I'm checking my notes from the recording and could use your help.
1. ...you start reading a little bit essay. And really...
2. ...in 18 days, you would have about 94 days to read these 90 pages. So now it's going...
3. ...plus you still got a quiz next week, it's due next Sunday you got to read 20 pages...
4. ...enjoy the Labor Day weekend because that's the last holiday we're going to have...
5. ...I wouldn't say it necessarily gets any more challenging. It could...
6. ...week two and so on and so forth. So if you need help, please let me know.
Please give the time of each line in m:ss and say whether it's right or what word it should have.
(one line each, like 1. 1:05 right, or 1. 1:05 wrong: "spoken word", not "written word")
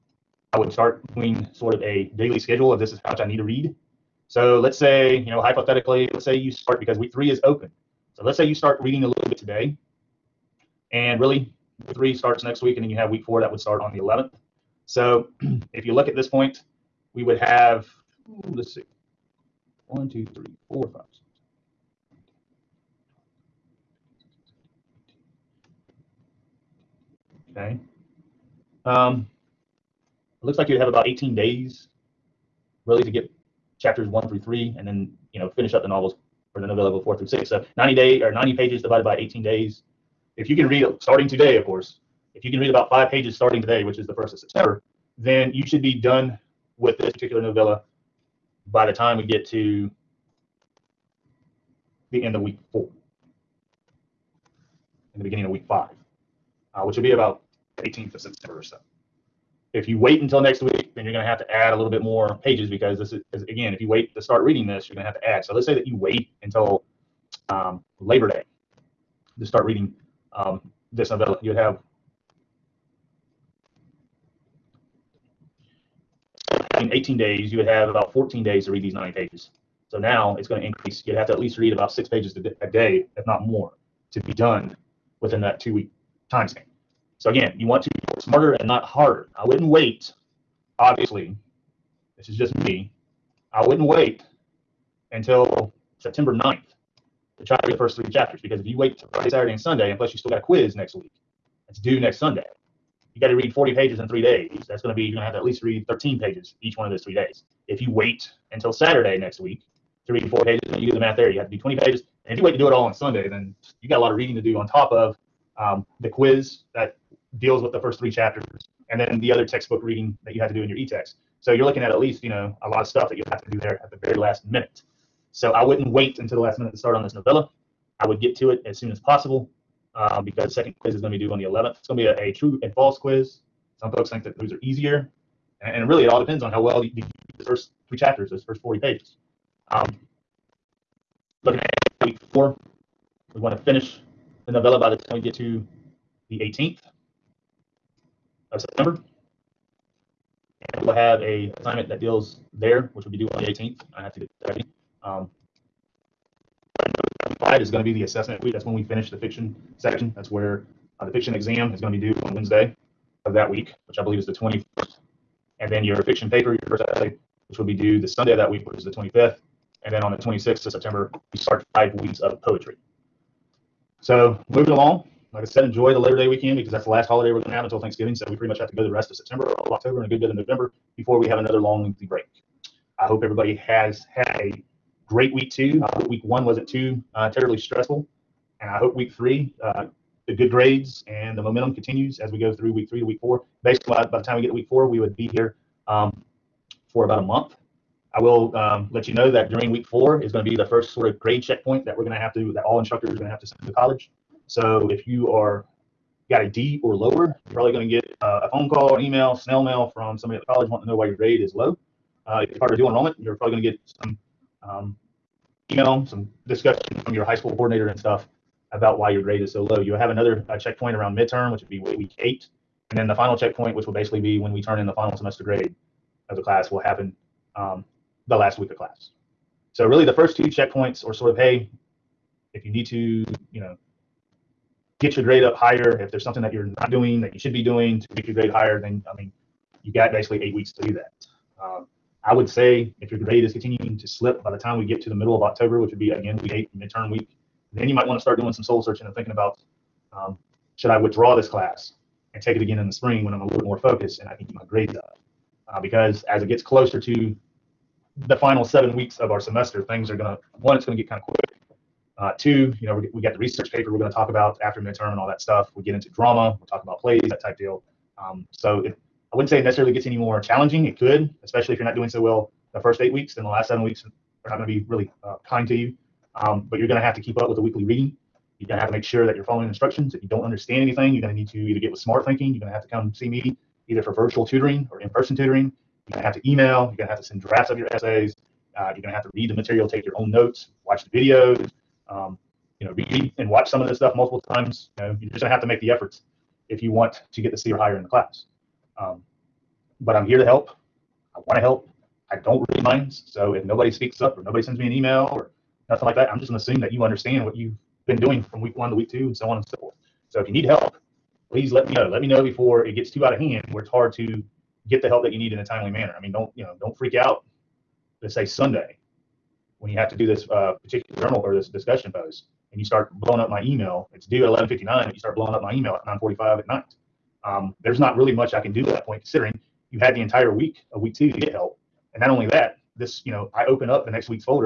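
1. 0:08 wrong: "today", not "essay"
2. 1:16 wrong: "14", not "94"
3. 1:39 wrong: "40", not "20"
4. 2:55 right
5. 4:29 right
6. 5:08 right.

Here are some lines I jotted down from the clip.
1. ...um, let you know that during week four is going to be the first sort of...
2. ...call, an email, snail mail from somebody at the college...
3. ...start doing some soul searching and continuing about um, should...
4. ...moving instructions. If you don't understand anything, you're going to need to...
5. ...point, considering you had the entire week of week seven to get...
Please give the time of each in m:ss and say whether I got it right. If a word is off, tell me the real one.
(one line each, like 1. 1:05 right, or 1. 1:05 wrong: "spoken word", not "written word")
1. 3:18 right
2. 3:28 right
3. 4:08 wrong: "thinking", not "continuing"
4. 4:39 wrong: "following", not "moving"
5. 5:29 wrong: "two", not "seven".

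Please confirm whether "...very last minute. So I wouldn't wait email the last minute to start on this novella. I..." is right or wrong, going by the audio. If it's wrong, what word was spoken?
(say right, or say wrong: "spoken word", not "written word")
wrong: "until", not "email".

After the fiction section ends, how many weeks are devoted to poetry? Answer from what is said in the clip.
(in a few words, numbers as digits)
5.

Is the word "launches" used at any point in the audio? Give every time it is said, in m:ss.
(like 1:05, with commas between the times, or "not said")
not said.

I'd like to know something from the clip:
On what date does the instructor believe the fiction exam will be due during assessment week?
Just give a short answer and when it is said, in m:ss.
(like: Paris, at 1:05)
21st, at 2:44.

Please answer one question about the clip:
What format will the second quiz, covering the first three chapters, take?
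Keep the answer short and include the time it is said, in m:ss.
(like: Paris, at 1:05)
true and false, at 2:12.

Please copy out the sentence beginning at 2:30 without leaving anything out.
And we'll have a assignment that deals there, which would be due on the 18th.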